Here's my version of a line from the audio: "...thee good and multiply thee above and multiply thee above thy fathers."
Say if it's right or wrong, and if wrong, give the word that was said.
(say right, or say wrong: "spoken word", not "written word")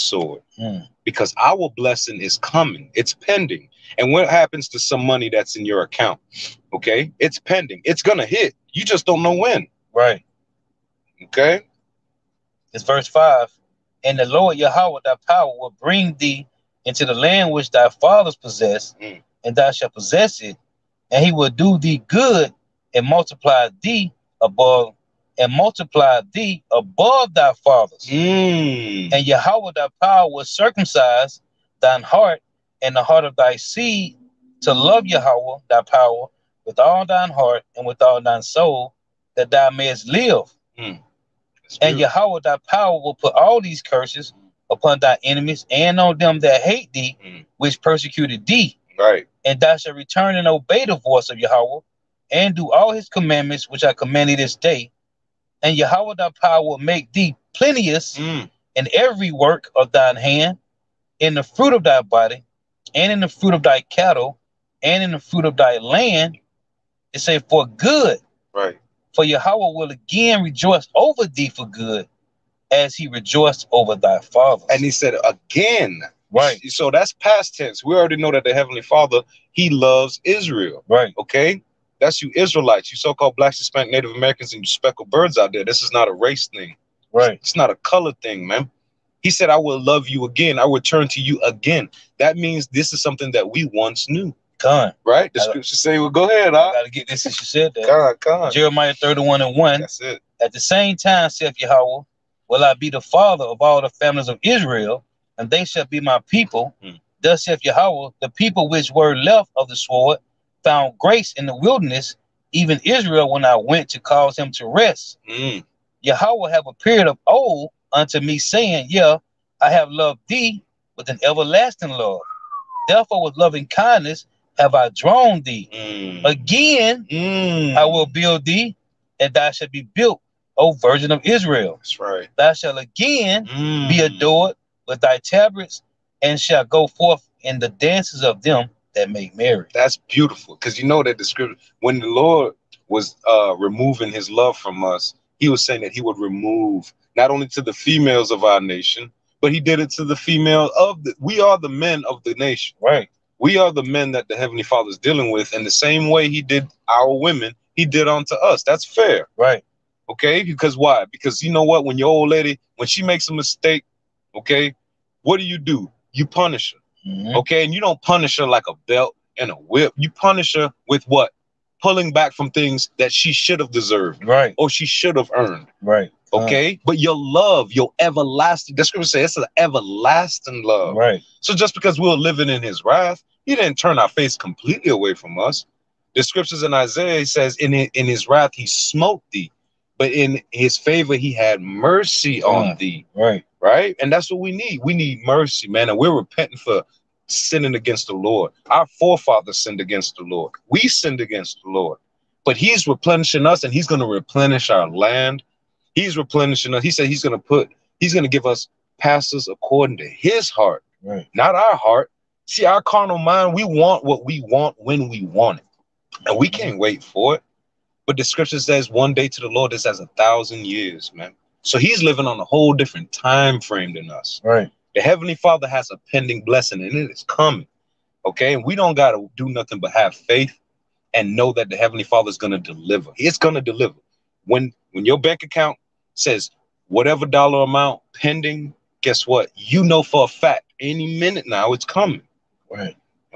right.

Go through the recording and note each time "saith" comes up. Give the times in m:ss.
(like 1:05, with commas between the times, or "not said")
1:41, 1:47.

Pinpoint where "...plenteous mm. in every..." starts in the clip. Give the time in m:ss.
0:57.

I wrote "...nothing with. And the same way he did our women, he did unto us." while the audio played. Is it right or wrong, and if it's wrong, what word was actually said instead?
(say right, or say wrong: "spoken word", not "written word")
wrong: "dealing", not "nothing".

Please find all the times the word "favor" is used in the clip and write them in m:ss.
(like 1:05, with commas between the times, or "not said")
3:10.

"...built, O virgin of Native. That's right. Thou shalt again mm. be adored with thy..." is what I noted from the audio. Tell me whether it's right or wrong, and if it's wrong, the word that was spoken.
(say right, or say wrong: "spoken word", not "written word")
wrong: "Israel", not "Native".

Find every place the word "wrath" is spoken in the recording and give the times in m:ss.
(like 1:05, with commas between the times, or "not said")
3:02, 3:08.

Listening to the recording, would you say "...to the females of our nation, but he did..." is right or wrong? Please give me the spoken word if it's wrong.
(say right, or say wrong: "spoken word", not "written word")
right.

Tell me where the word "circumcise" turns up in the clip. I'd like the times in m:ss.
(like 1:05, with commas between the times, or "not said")
0:30.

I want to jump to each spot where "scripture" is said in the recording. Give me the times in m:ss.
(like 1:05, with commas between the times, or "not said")
1:35, 2:21, 2:58, 3:06, 3:38.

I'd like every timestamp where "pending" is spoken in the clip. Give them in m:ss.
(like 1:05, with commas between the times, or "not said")
0:03, 0:07, 3:46, 3:58.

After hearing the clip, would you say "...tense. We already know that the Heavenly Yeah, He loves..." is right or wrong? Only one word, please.
wrong.